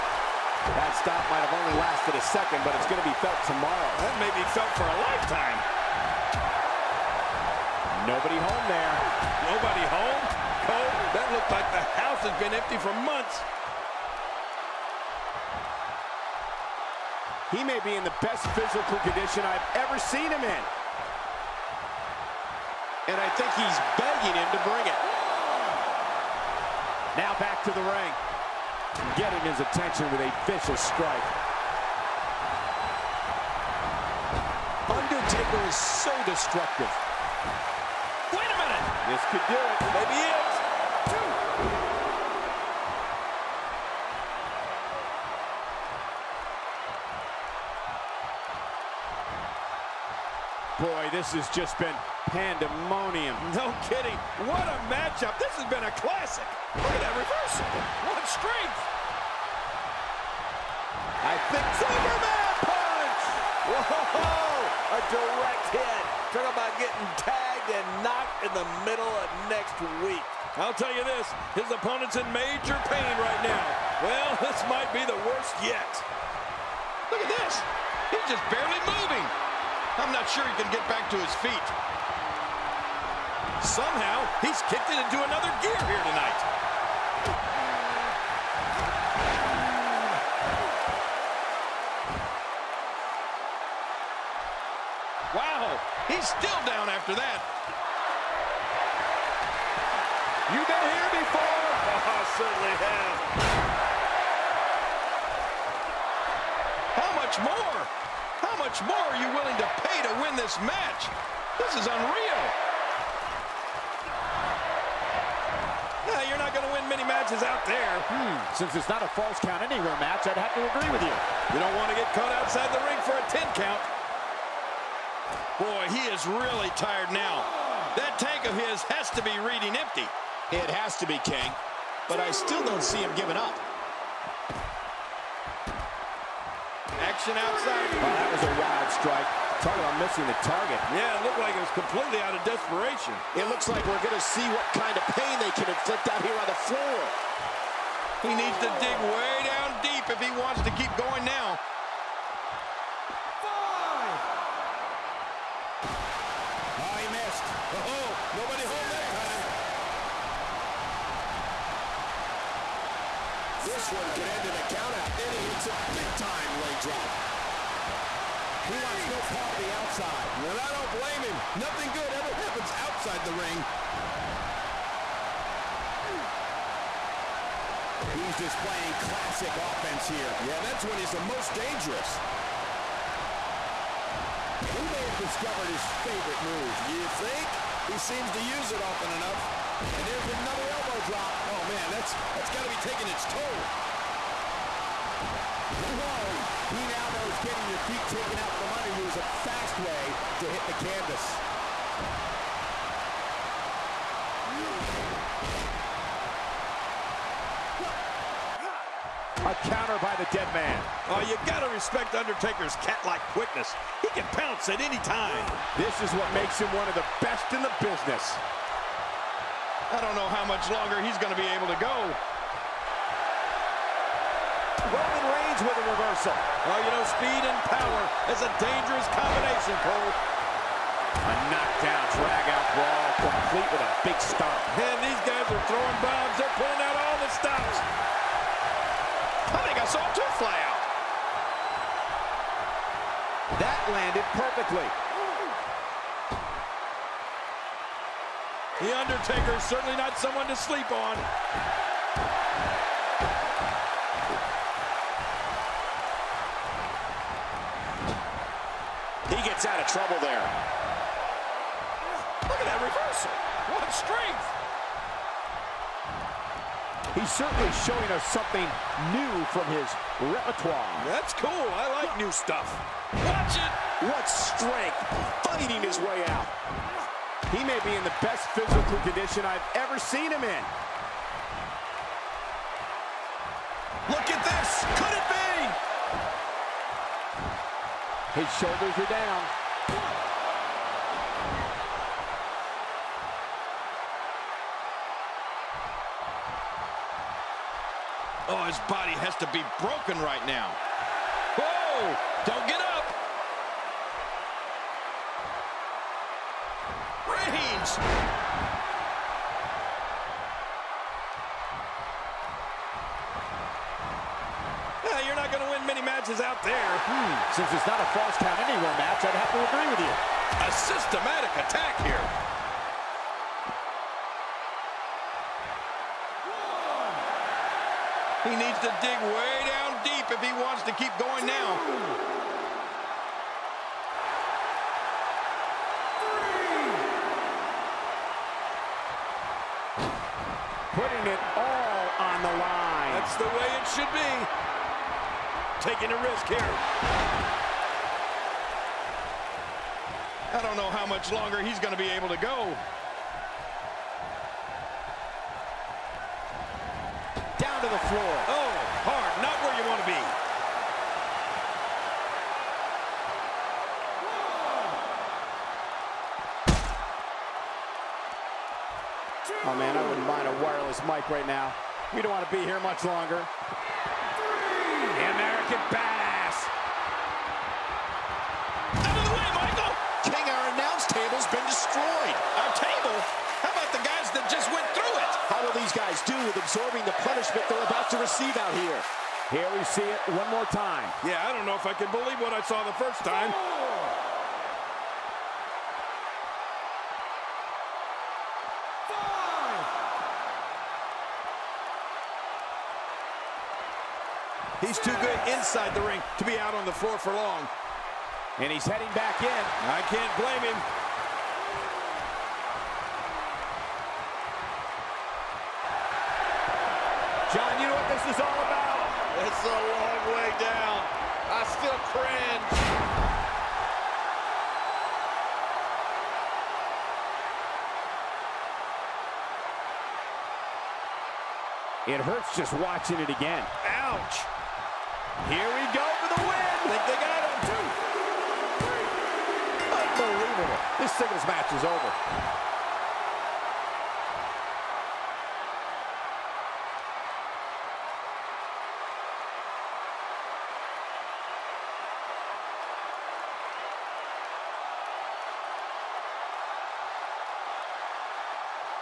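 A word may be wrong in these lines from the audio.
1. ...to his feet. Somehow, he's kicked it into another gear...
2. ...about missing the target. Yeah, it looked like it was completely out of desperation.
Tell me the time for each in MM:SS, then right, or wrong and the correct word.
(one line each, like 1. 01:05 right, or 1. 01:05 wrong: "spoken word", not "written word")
1. 01:21 right
2. 02:19 right.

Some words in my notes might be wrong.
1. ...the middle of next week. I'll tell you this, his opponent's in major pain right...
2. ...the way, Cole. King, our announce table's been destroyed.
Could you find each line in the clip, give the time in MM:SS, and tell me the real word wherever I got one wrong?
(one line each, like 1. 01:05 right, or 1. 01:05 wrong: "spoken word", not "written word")
1. 01:08 right
2. 06:19 wrong: "Michael", not "Cole".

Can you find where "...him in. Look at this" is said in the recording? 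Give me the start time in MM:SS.
04:40.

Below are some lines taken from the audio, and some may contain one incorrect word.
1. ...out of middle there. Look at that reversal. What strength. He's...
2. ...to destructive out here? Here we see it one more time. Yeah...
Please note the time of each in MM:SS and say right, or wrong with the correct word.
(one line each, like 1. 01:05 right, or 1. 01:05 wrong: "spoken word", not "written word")
1. 04:19 wrong: "trouble", not "middle"
2. 06:28 wrong: "receive", not "destructive".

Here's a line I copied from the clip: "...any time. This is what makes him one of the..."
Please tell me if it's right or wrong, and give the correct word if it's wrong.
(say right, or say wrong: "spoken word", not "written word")
right.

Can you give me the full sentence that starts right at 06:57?
John, you know what this is all about?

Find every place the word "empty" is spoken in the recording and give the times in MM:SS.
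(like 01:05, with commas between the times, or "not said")
00:12, 02:09.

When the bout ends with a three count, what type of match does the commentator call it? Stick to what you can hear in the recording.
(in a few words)
Singles match.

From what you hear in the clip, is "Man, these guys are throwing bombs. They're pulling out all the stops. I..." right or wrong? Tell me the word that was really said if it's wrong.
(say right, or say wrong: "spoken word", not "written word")
right.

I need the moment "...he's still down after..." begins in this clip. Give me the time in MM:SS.
01:36.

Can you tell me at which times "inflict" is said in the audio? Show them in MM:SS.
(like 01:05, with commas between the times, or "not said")
02:25.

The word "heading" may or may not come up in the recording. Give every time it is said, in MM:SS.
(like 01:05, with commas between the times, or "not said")
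06:48.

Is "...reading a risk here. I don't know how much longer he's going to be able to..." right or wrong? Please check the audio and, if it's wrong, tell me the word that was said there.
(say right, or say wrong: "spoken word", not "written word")
wrong: "taking", not "reading".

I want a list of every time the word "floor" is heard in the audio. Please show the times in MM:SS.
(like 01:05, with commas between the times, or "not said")
02:26, 05:58, 06:46.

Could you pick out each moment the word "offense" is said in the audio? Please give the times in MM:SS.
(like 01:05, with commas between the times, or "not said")
02:59.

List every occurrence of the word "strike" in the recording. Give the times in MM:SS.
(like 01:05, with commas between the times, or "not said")
00:30, 02:18.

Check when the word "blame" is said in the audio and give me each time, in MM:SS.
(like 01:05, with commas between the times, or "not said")
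02:50, 06:50.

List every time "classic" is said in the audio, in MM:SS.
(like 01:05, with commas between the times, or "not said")
00:55, 02:59.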